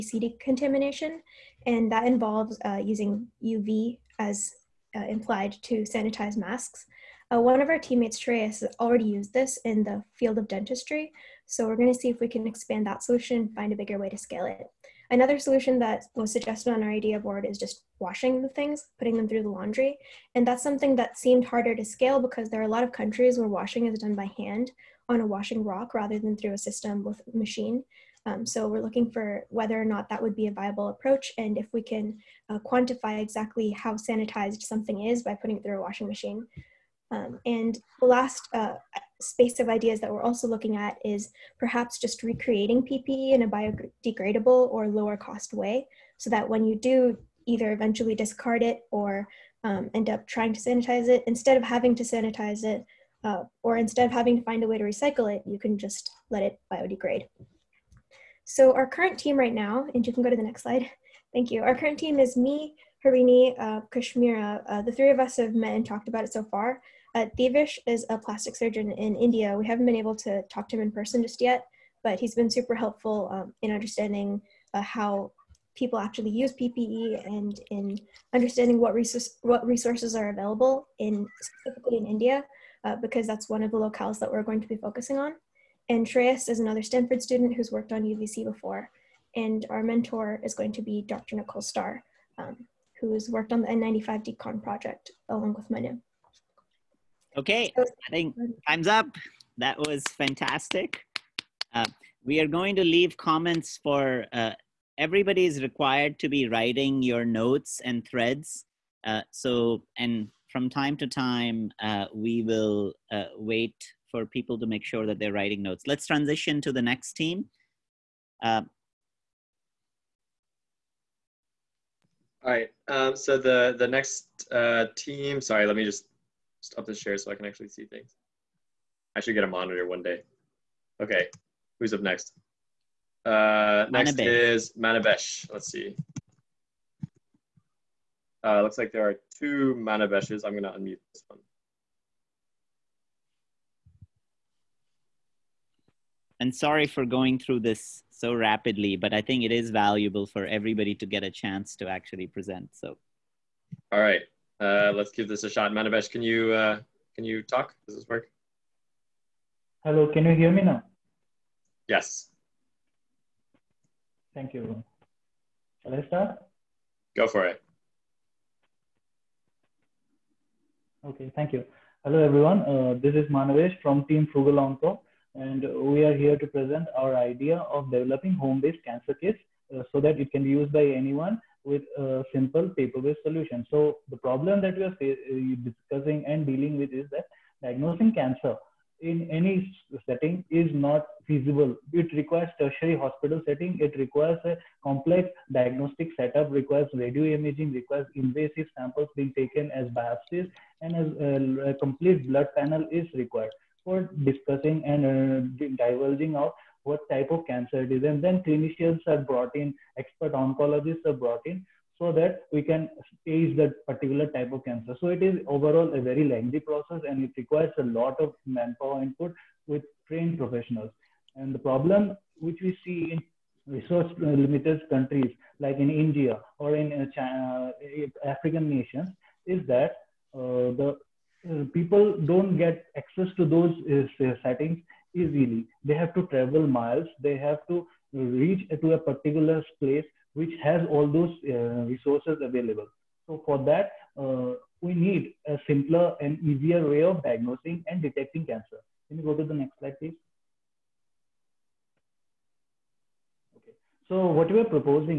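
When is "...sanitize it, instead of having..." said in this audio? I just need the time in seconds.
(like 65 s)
50 s.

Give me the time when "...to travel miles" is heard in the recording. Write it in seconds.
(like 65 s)
236 s.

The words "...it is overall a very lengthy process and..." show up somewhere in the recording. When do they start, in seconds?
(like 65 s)
215 s.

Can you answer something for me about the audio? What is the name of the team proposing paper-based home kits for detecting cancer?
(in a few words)
Frugal Onco.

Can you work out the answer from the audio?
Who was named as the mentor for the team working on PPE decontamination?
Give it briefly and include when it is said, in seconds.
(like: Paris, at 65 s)
Dr. Nicole Starr, at 91 s.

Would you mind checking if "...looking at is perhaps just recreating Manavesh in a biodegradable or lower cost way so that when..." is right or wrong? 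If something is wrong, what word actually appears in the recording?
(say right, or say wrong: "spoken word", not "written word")
wrong: "PPE", not "Manavesh".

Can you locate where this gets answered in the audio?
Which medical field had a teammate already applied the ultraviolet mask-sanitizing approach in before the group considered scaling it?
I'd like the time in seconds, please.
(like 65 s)
10 s.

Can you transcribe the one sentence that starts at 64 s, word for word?
Uh, the three of us have met and talked about it so far.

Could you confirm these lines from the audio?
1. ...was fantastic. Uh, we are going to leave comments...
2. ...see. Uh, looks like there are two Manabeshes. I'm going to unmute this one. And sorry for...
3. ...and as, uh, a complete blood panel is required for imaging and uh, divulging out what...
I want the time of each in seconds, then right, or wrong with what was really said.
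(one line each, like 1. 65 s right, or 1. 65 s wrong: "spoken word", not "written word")
1. 99 s right
2. 135 s right
3. 200 s wrong: "discussing", not "imaging".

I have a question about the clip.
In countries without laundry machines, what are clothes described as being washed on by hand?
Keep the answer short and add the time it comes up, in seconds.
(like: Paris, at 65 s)
a washing rock, at 25 s.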